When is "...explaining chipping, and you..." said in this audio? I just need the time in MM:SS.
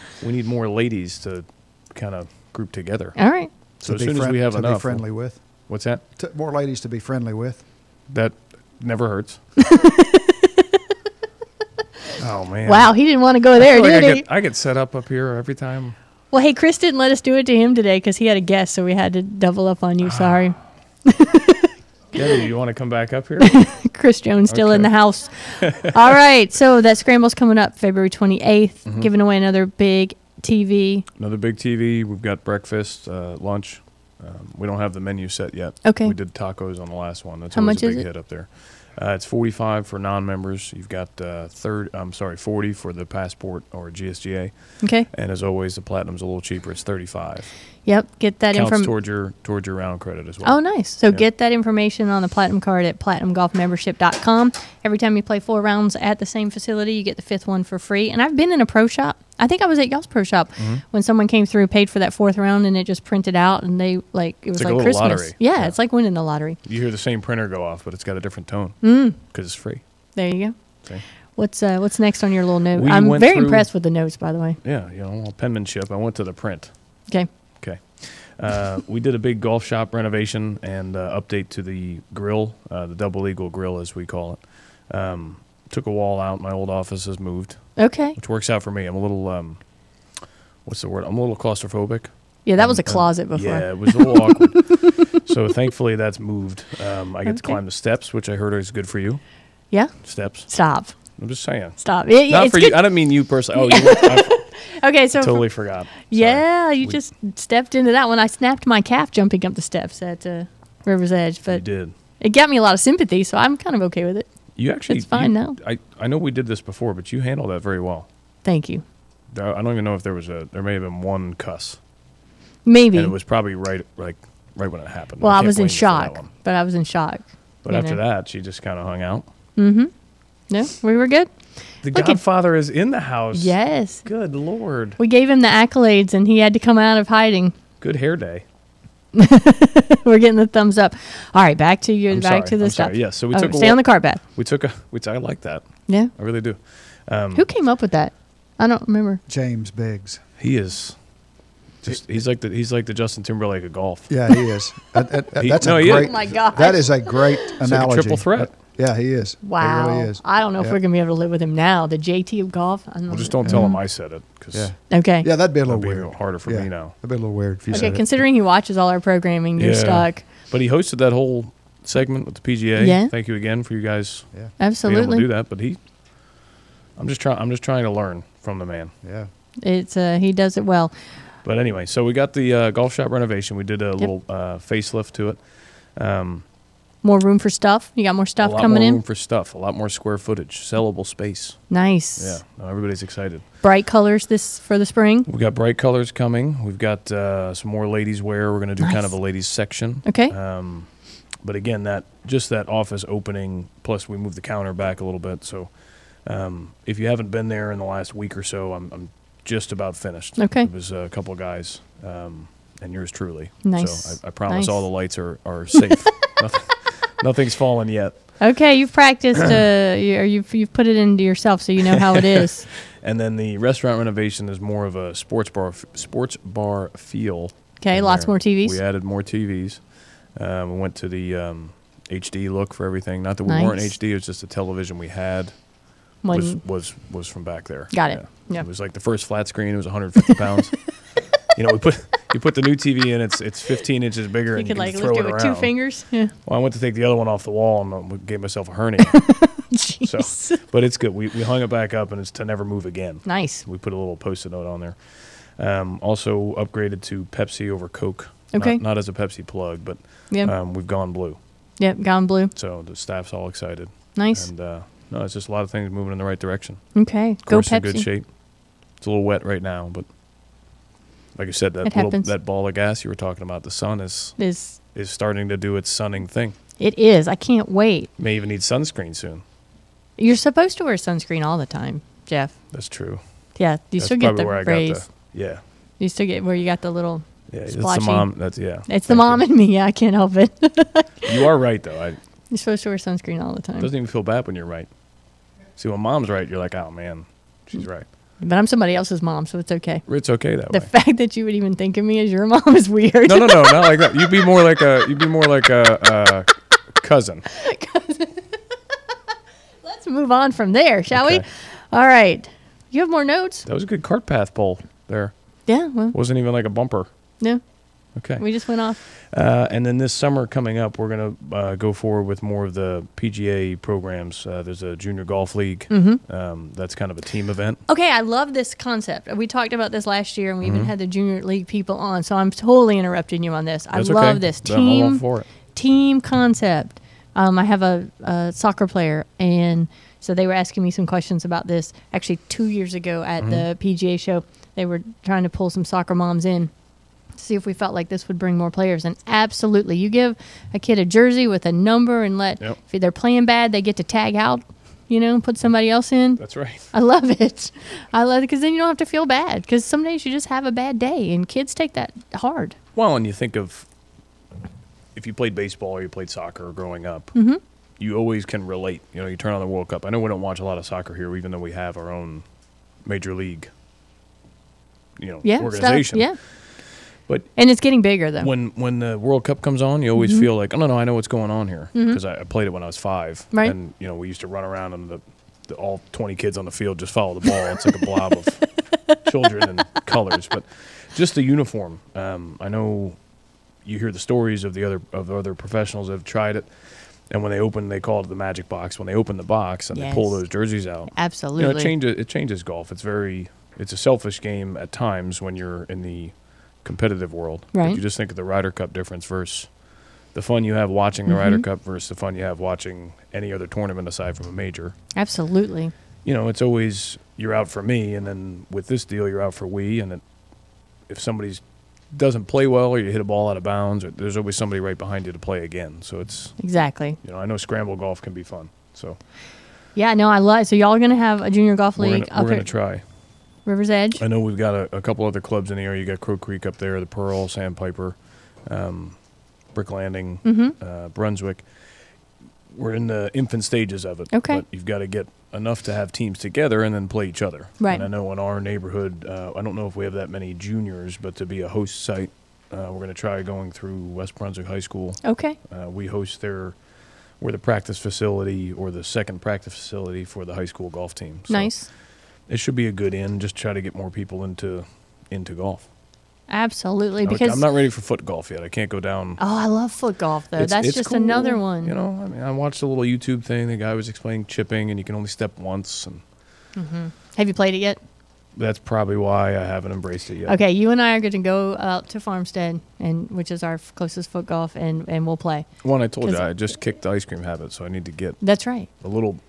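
07:54.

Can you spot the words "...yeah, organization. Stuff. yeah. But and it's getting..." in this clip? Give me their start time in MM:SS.
06:15.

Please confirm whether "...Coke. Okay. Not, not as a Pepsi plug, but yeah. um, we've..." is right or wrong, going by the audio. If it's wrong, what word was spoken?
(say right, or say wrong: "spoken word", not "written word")
right.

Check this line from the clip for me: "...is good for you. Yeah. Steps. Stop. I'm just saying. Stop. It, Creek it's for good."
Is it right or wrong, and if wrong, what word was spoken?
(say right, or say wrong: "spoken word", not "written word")
wrong: "Not", not "Creek".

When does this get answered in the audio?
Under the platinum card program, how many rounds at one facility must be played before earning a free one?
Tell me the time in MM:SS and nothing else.
00:55.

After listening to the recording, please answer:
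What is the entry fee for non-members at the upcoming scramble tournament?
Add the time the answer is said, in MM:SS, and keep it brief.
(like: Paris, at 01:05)
45, at 00:39.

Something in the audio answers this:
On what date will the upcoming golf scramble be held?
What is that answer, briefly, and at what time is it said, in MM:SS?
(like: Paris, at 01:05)
February 28th, at 00:27.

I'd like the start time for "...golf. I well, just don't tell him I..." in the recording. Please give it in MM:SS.
02:42.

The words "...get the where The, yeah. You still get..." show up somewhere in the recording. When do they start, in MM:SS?
04:44.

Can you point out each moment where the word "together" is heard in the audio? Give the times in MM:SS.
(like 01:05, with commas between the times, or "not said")
00:02, 07:26.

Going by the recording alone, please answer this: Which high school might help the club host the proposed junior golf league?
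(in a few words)
West Brunswick High School.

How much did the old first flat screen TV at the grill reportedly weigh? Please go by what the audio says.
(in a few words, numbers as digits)
150 pounds.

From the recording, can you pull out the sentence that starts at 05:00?
The fact that you would even think of me as your mom is weird.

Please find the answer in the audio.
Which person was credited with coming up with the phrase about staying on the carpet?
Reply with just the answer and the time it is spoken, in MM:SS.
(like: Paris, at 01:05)
James Biggs, at 02:29.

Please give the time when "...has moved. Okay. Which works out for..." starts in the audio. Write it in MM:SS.
01:27.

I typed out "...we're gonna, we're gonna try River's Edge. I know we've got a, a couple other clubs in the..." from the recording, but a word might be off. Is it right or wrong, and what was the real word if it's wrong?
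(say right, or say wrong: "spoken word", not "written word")
right.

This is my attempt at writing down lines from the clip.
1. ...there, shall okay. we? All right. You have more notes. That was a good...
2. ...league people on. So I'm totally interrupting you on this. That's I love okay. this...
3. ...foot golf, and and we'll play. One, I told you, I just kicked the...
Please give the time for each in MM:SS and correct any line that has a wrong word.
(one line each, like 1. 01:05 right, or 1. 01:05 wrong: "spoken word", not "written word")
1. 05:10 right
2. 05:31 right
3. 08:04 right.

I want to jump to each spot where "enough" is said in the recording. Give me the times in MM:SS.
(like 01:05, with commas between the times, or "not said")
00:04, 07:25.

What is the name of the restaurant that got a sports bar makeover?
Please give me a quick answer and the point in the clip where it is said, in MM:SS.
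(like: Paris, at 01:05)
Double Eagle Grill, at 01:22.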